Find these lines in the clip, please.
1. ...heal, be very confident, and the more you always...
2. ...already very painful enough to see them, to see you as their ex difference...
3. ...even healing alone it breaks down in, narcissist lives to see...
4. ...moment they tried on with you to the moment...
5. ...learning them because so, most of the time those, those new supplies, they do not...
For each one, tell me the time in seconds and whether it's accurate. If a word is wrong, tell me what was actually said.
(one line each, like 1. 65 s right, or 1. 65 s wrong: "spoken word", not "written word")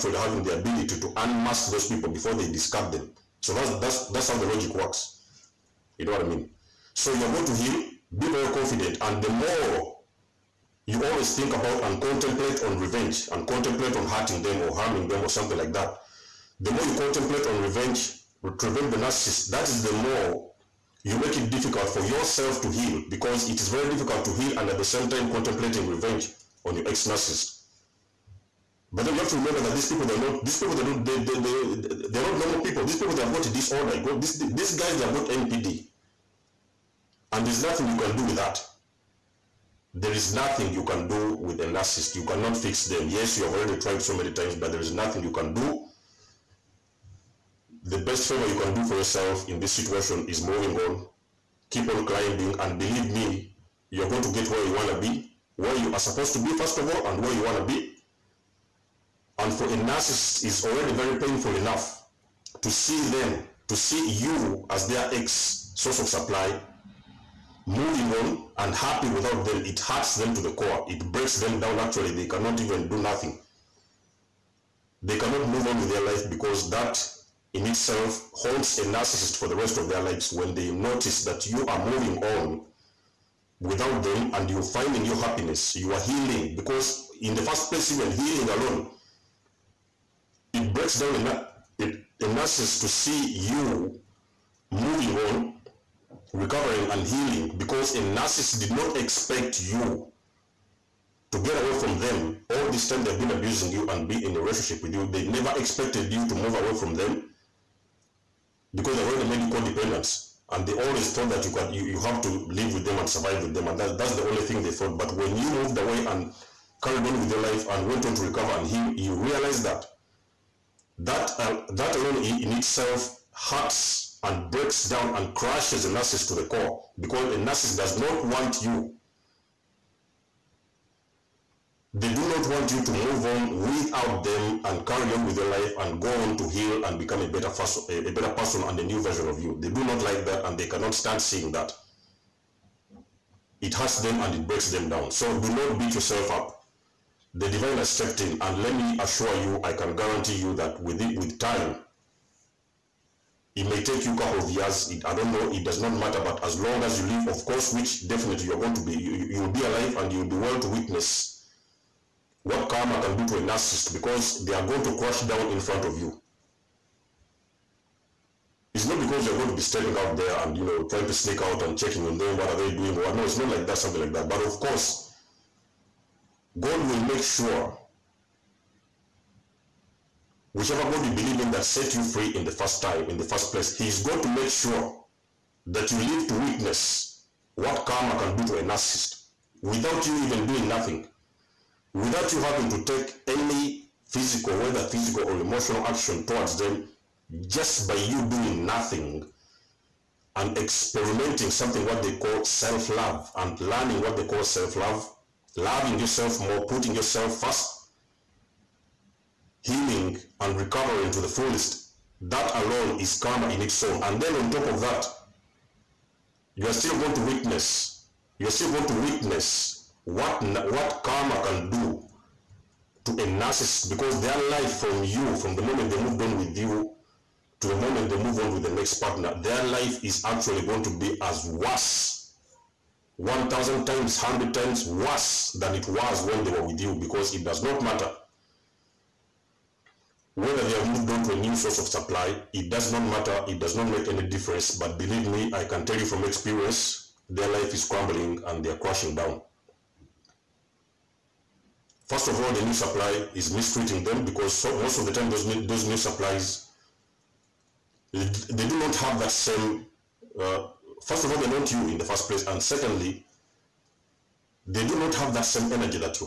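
1. 7 s right
2. 60 s wrong: "source", not "difference"
3. 87 s wrong: "nurses", not "lives"
4. 225 s wrong: "moved", not "tried"
5. 253 s wrong: "mistreating", not "learning".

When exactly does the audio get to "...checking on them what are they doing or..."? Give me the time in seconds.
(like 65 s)
171 s.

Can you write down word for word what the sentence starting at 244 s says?
But believe me, I can tell you from experience, their life is crumbling and they are crashing down.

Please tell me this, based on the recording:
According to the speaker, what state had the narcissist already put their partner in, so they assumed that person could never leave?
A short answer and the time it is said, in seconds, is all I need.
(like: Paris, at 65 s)
codependent, at 109 s.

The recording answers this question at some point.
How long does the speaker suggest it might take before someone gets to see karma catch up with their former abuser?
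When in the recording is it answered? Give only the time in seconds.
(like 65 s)
154 s.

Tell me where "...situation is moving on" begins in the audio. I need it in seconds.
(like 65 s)
49 s.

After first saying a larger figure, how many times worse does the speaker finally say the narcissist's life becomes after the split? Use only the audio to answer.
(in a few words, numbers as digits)
100 times.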